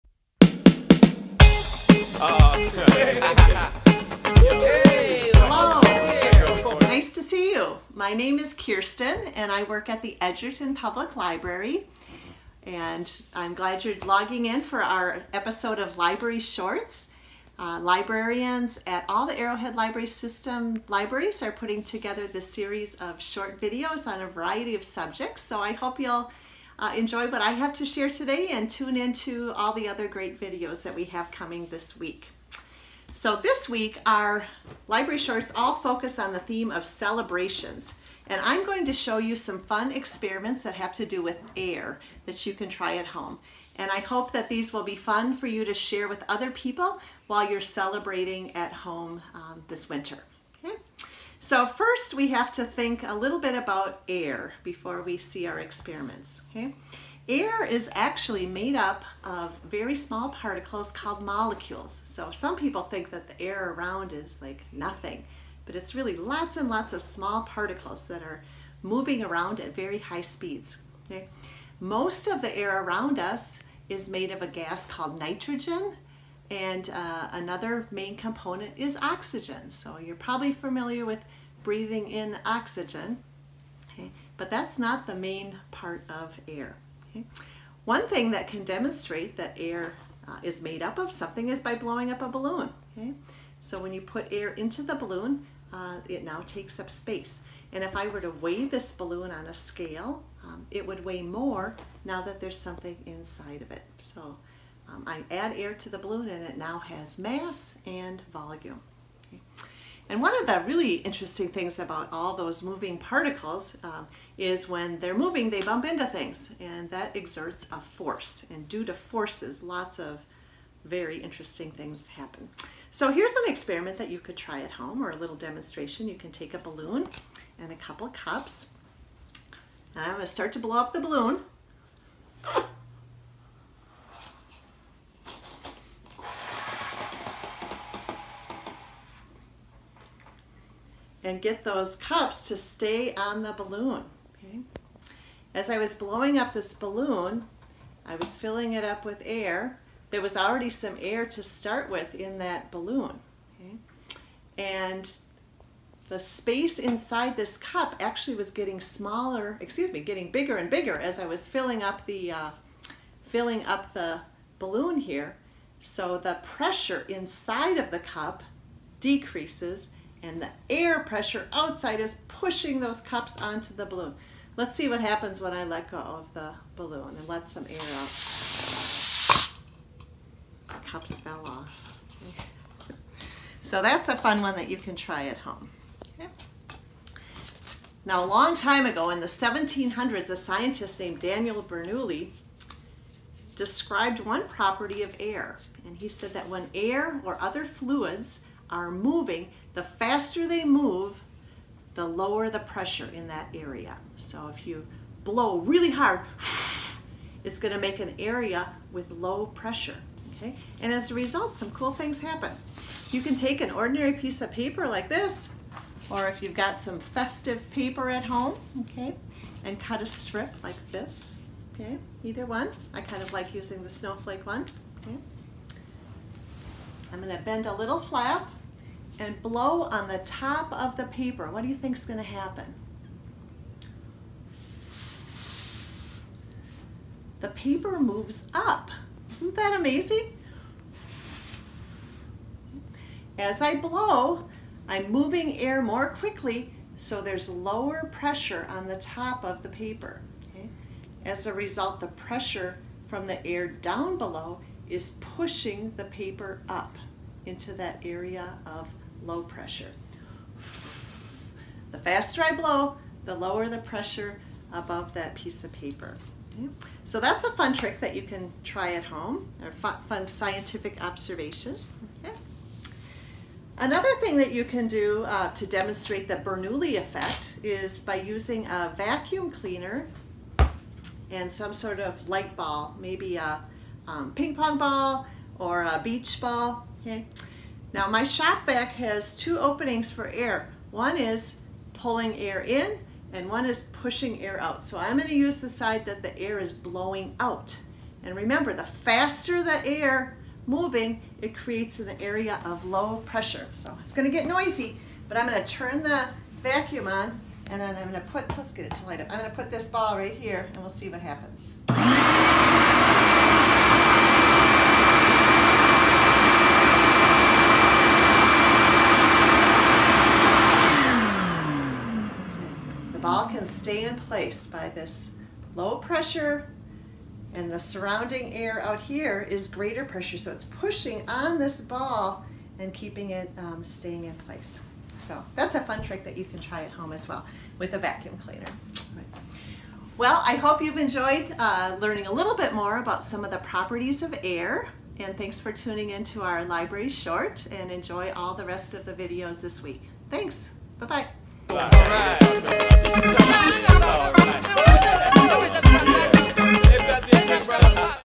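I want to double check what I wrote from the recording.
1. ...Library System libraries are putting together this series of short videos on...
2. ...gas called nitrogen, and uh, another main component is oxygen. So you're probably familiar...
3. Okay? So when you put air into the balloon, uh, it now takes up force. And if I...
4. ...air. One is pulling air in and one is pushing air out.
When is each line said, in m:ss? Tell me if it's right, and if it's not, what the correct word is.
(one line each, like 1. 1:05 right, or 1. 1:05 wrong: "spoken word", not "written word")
1. 0:19 right
2. 1:14 right
3. 1:32 wrong: "space", not "force"
4. 4:50 right.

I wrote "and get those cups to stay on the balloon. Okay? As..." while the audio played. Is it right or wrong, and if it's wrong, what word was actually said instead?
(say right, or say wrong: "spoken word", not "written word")
right.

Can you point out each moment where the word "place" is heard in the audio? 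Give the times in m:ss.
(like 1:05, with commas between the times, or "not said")
5:24, 5:34.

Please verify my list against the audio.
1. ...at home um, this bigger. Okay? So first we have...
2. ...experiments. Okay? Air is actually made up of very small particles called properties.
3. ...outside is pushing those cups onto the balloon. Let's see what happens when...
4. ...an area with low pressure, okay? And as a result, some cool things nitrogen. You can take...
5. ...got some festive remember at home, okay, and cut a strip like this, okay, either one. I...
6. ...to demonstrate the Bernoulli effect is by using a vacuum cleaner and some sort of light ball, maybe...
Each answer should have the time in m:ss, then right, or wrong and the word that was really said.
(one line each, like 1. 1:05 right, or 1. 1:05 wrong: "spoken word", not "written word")
1. 0:48 wrong: "winter", not "bigger"
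2. 0:55 wrong: "molecules", not "properties"
3. 2:51 right
4. 3:27 wrong: "happen", not "nitrogen"
5. 3:36 wrong: "paper", not "remember"
6. 4:35 right.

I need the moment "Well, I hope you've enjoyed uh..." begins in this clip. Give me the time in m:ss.
5:40.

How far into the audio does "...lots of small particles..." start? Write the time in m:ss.
1:06.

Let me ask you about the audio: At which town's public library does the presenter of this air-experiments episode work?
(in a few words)
Edgerton.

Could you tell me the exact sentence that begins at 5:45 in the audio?
And thanks for tuning into our library short and enjoy all the rest of the videos this week.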